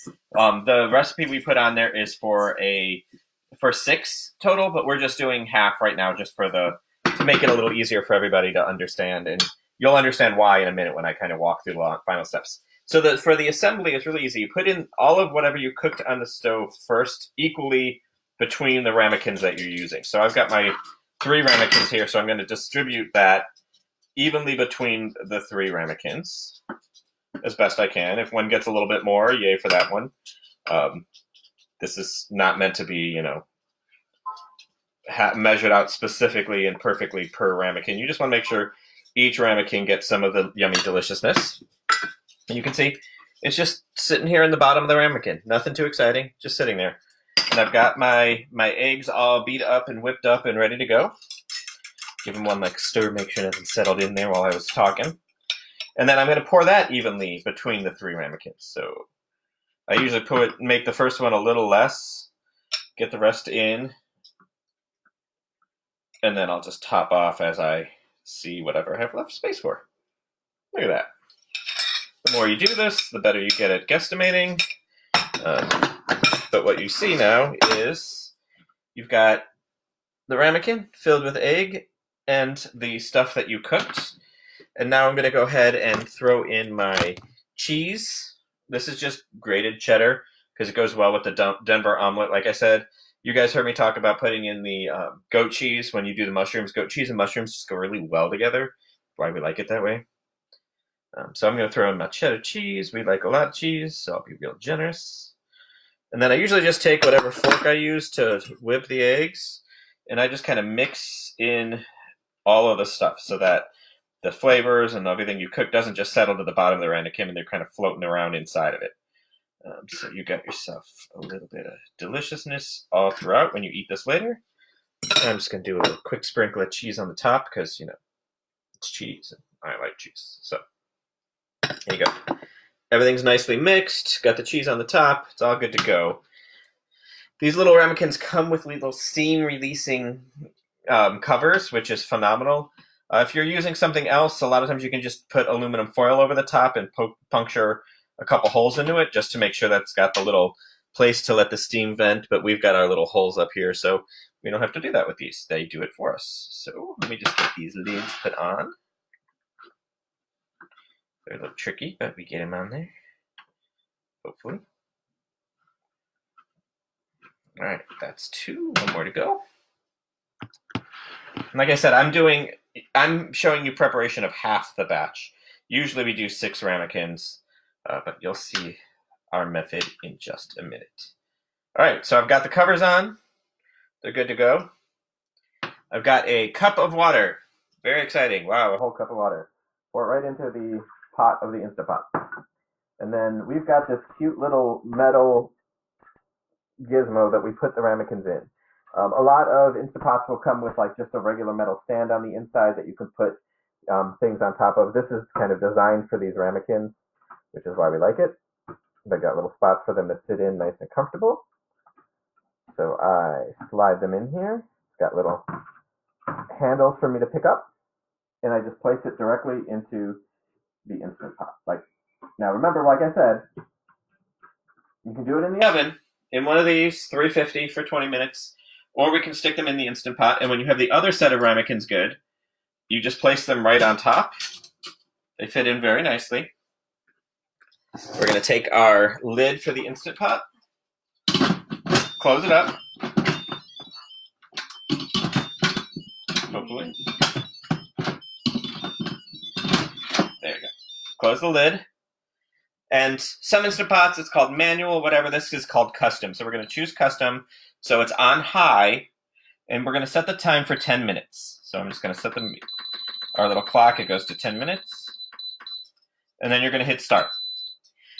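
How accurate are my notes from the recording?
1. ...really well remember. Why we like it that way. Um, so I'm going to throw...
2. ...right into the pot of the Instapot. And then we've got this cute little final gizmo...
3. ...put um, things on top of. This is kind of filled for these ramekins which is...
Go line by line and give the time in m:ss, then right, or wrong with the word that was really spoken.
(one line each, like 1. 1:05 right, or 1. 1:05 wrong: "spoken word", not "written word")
1. 1:37 wrong: "together", not "remember"
2. 3:10 wrong: "metal", not "final"
3. 3:23 wrong: "designed", not "filled".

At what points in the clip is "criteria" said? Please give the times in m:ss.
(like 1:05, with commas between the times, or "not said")
not said.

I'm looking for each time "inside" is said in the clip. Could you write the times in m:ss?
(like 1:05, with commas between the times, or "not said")
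1:58, 3:22.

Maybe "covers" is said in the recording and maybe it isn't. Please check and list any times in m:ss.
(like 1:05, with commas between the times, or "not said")
2:21, 3:02.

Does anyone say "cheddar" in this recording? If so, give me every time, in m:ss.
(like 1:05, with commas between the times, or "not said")
1:29, 1:42.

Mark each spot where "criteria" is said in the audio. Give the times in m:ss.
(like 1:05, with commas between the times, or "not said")
not said.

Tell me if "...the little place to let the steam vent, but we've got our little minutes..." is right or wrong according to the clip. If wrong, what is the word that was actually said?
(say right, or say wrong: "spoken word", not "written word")
wrong: "holes", not "minutes".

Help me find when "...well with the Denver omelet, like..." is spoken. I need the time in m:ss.
1:30.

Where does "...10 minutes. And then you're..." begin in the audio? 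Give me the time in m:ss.
4:24.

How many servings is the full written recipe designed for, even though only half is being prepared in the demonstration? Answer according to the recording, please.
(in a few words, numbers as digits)
6.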